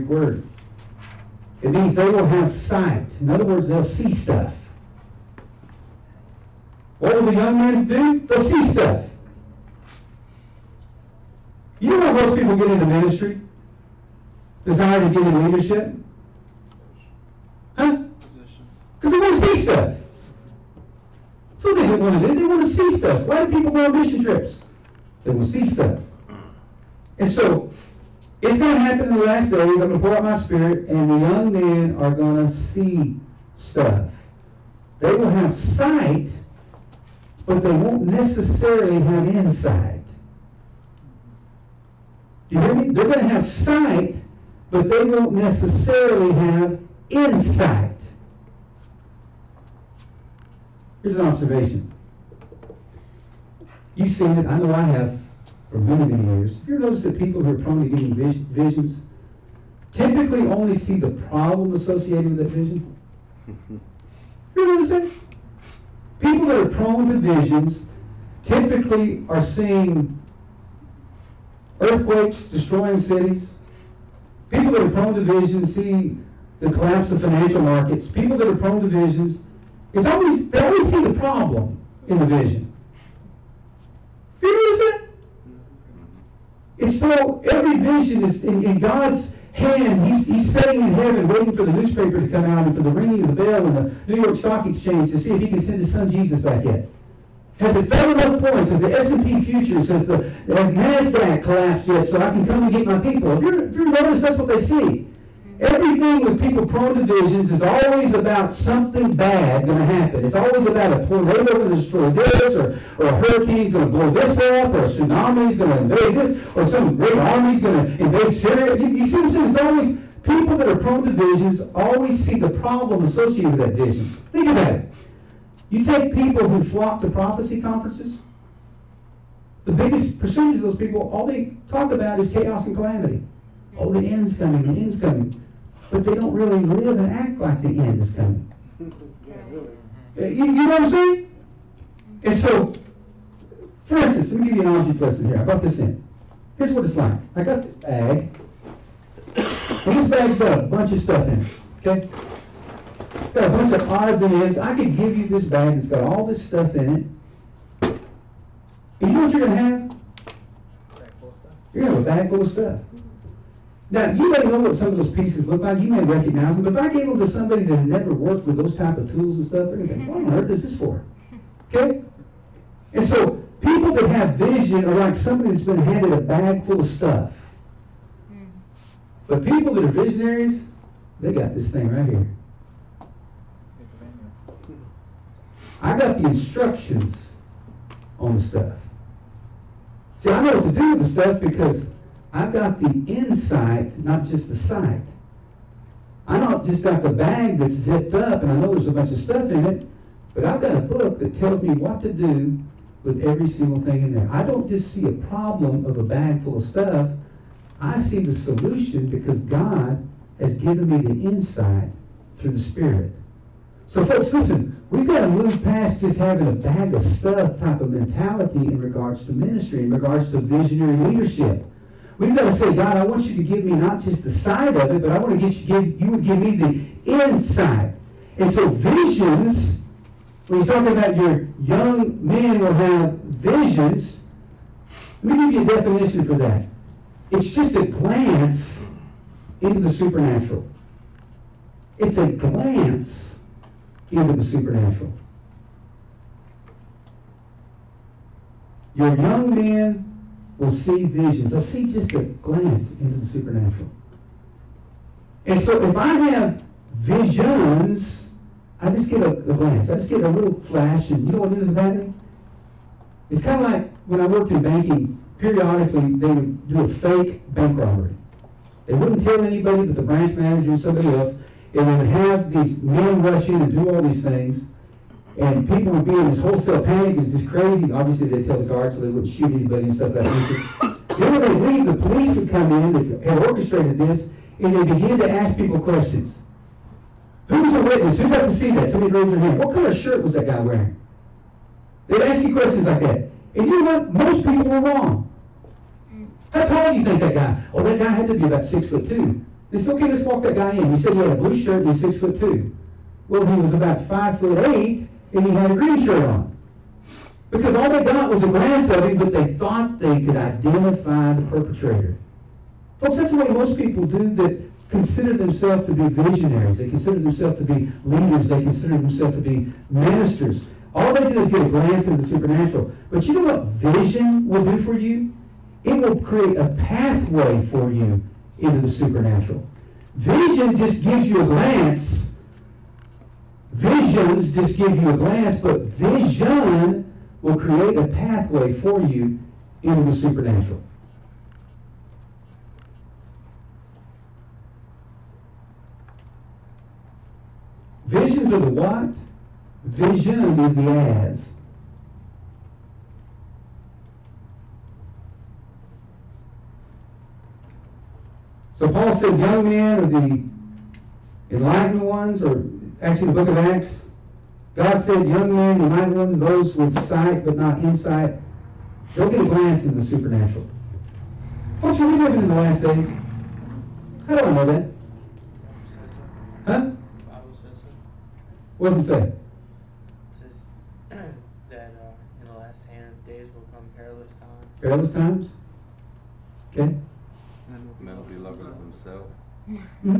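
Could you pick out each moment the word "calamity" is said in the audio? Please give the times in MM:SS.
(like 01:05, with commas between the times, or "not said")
02:12.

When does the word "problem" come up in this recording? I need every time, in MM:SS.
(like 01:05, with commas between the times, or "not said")
01:01, 01:21, 02:02, 03:25.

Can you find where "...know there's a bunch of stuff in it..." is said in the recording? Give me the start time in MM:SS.
03:18.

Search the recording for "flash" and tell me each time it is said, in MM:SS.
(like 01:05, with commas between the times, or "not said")
04:20.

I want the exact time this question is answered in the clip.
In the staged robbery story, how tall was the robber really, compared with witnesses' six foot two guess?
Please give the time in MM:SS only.
05:04.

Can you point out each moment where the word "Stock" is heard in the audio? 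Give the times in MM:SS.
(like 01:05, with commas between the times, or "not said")
01:34.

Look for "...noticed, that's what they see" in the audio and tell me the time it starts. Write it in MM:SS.
01:43.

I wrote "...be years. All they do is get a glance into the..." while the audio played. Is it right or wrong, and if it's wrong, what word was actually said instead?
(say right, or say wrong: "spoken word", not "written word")
wrong: "ministers", not "years".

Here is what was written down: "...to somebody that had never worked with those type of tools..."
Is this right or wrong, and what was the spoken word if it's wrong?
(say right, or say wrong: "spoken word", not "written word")
right.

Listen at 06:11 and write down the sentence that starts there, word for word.
Folks, are we living in the last days?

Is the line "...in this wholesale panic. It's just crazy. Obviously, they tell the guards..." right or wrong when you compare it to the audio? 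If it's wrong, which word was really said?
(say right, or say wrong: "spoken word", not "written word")
right.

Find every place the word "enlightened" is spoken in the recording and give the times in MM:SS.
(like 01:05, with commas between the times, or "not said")
06:01, 06:05.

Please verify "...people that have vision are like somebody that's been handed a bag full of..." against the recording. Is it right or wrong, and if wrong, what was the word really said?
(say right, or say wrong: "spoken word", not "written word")
right.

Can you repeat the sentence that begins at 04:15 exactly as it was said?
And so if I have visions, I just get a, a glance.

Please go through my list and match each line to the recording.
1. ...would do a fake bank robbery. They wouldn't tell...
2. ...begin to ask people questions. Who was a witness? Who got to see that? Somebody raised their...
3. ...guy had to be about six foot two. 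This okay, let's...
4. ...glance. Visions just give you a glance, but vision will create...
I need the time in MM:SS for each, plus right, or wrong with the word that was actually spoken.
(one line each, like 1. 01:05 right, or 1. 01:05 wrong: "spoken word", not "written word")
1. 04:26 right
2. 04:44 right
3. 04:57 right
4. 05:31 right.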